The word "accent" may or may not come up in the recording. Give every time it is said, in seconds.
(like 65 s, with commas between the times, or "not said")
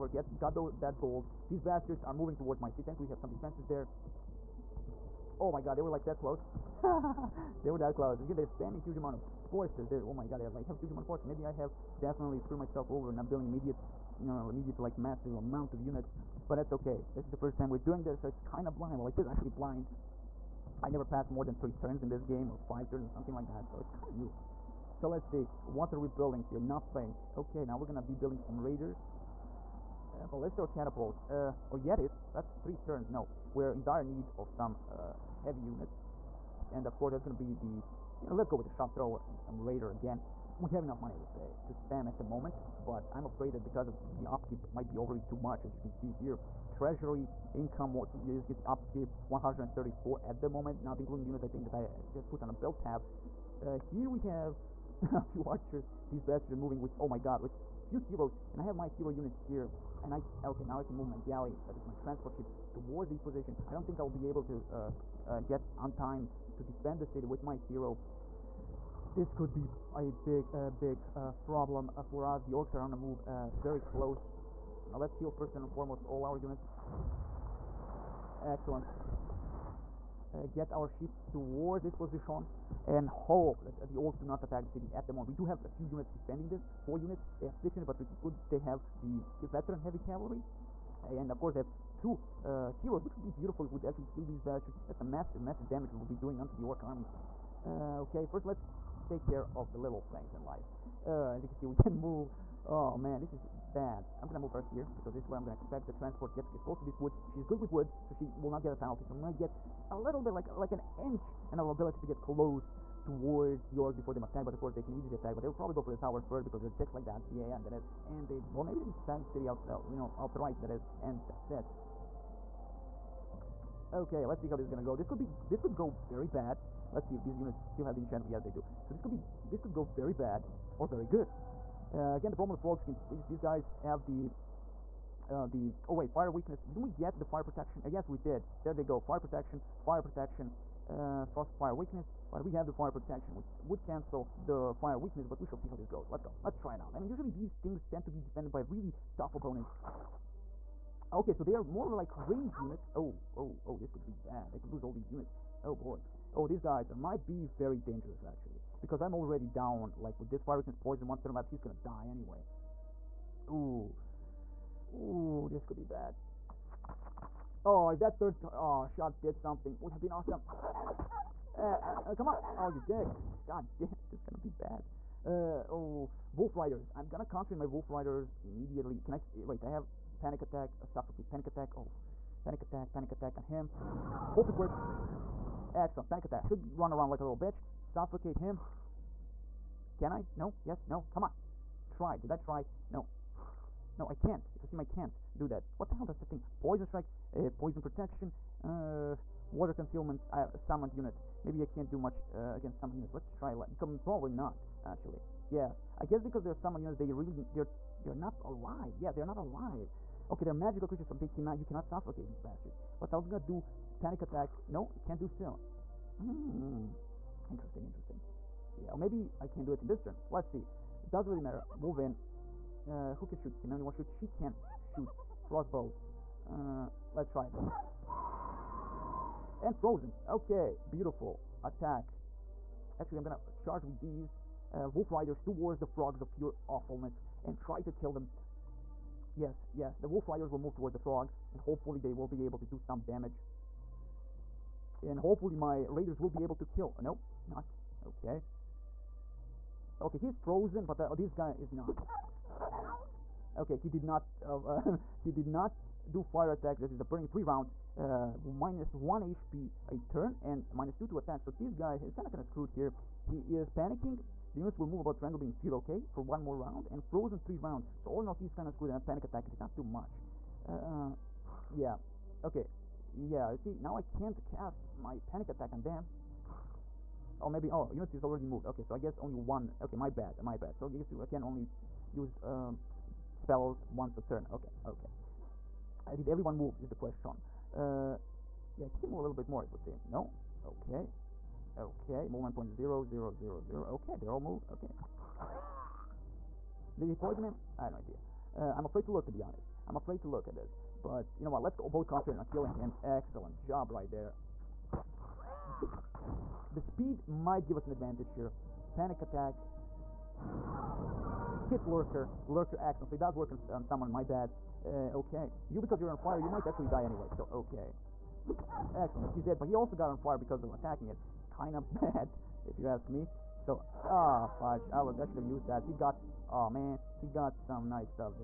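312 s.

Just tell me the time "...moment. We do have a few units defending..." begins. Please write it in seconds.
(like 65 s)
85 s.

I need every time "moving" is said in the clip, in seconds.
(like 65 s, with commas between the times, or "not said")
2 s, 56 s.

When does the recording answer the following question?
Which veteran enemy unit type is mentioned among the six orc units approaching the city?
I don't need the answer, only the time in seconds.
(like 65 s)
89 s.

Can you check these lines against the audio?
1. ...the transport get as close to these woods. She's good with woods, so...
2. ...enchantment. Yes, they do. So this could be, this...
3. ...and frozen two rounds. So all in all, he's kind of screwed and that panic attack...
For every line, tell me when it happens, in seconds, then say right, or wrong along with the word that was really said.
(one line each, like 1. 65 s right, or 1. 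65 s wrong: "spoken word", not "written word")
1. 105 s right
2. 127 s right
3. 266 s wrong: "three", not "two".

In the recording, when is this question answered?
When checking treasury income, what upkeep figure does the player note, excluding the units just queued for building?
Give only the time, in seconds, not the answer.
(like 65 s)
48 s.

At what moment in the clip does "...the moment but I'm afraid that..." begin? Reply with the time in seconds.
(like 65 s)
42 s.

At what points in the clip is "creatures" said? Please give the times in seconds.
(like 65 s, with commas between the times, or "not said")
210 s.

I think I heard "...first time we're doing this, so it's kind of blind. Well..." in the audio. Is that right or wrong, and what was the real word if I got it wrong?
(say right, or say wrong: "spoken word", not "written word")
right.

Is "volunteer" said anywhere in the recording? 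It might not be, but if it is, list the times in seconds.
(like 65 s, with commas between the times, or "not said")
not said.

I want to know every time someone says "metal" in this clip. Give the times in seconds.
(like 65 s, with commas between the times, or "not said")
not said.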